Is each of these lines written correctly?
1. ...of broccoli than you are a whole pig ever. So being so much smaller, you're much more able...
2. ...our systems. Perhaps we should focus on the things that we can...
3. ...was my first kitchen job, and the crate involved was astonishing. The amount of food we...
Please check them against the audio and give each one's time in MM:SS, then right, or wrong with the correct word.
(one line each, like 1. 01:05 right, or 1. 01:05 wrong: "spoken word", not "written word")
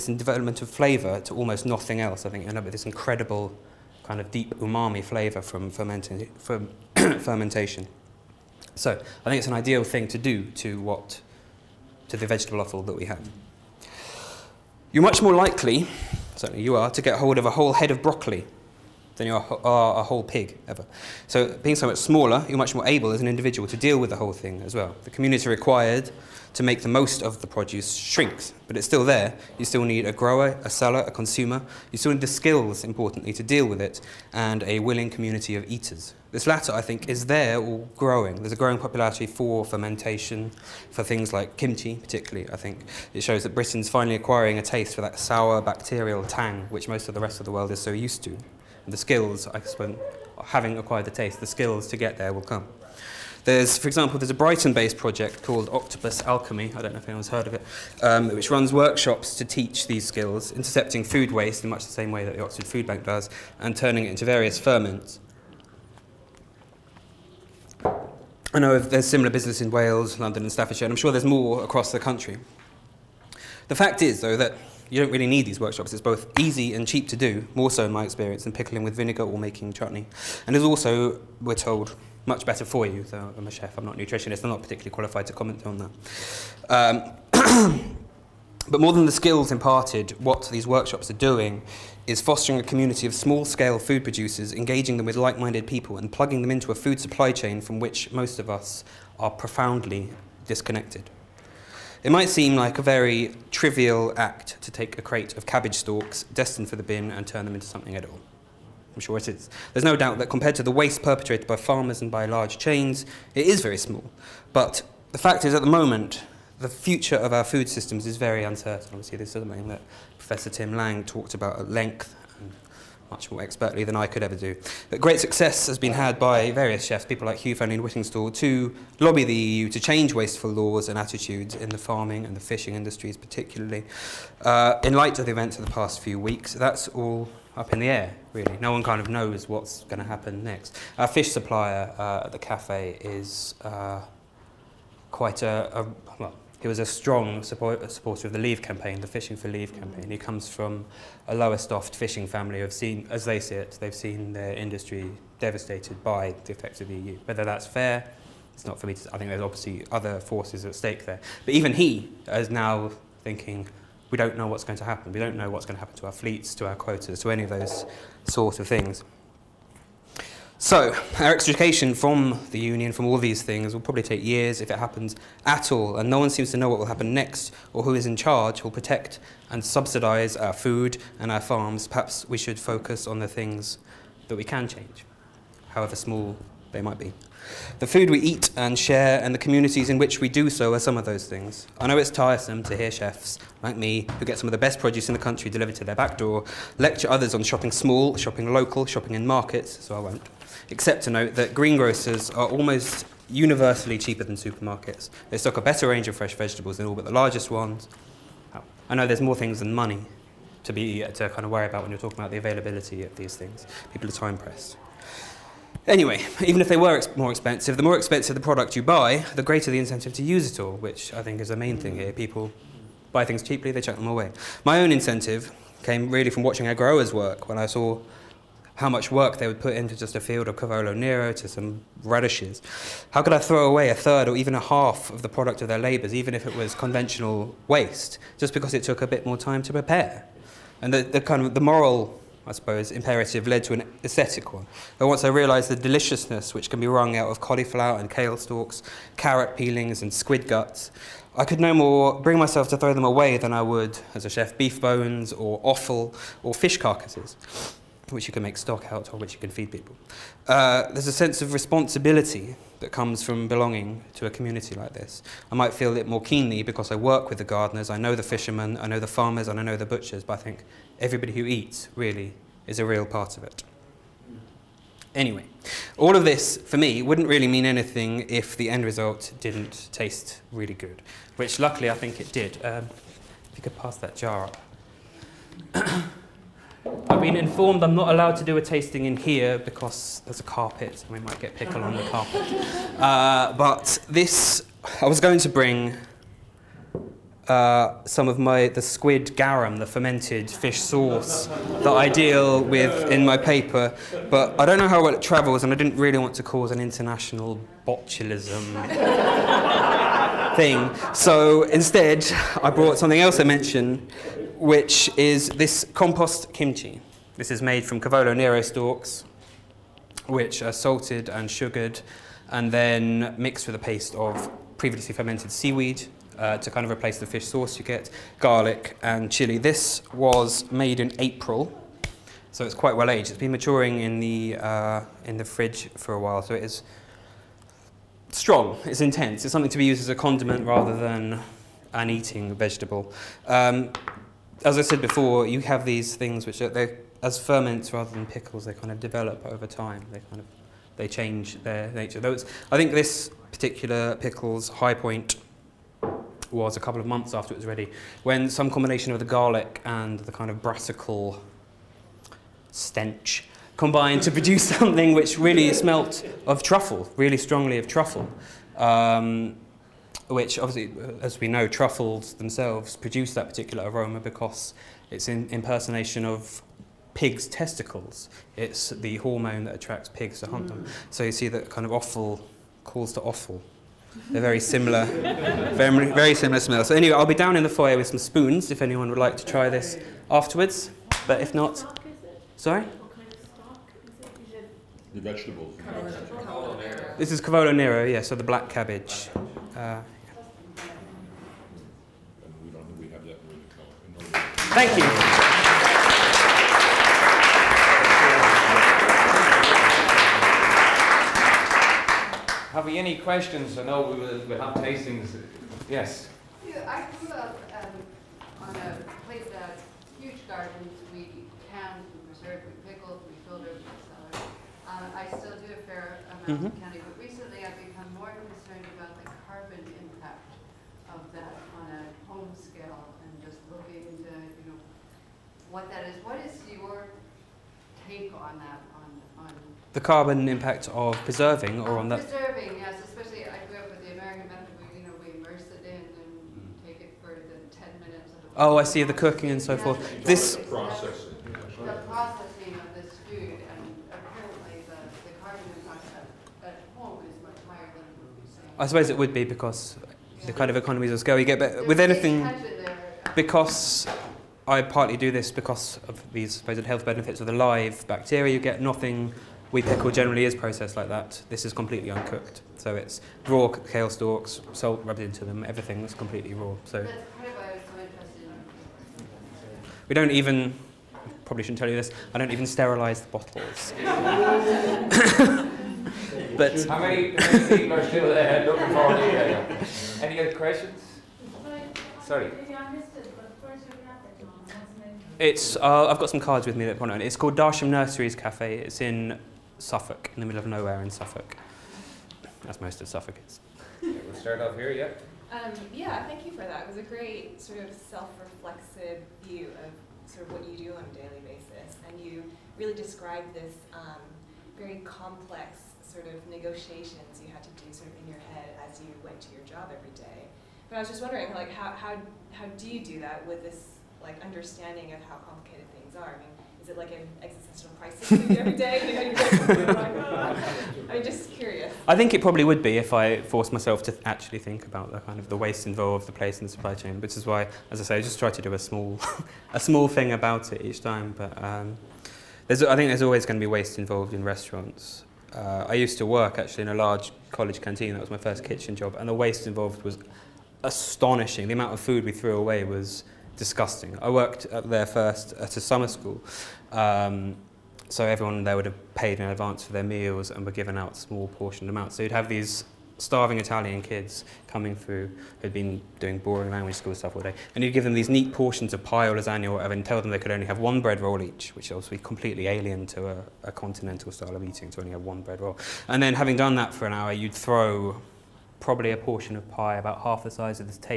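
1. 00:17 right
2. 03:01 wrong: "farms", not "systems"
3. 09:08 wrong: "waste", not "crate".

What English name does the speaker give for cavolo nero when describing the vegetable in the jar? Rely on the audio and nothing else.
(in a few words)
Black cabbage.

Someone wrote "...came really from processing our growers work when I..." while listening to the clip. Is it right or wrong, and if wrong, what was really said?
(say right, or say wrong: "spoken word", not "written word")
wrong: "watching", not "processing".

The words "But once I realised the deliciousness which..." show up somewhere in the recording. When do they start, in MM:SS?
04:04.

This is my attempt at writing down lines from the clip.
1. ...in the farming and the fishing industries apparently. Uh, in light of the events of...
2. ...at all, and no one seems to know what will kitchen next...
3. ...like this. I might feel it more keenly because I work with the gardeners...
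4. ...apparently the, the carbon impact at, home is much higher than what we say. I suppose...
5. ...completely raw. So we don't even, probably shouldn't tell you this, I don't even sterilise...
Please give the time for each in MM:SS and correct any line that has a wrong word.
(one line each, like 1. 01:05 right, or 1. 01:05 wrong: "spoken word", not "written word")
1. 02:11 wrong: "particularly", not "apparently"
2. 02:55 wrong: "happen", not "kitchen"
3. 04:24 right
4. 07:34 right
5. 07:56 right.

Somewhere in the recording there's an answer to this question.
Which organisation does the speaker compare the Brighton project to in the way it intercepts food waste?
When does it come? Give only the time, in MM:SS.
01:02.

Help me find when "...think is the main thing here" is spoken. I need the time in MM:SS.
03:41.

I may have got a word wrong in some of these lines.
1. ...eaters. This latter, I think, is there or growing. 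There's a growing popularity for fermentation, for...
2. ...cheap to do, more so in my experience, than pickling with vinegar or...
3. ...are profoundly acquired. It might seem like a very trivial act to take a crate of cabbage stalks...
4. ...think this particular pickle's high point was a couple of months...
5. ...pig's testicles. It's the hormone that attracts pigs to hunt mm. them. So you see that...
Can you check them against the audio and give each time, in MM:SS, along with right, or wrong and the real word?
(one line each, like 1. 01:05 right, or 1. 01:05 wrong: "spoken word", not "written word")
1. 00:35 right
2. 01:16 right
3. 01:39 wrong: "disconnected", not "acquired"
4. 05:52 right
5. 06:17 right.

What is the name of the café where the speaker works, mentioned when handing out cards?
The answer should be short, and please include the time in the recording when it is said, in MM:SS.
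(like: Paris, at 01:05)
Darsham Nurseries Cafe, at 08:17.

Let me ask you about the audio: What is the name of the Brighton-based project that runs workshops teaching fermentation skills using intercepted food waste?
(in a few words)
Octopus Alchemy.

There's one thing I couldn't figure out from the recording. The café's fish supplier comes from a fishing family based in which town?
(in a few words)
Lowestoft.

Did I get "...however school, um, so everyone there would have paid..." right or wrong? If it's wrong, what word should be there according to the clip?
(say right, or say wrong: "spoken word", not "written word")
wrong: "summer", not "however".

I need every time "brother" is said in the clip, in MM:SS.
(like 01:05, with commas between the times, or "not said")
not said.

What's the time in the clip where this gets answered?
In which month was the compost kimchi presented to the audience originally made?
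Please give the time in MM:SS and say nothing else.
05:31.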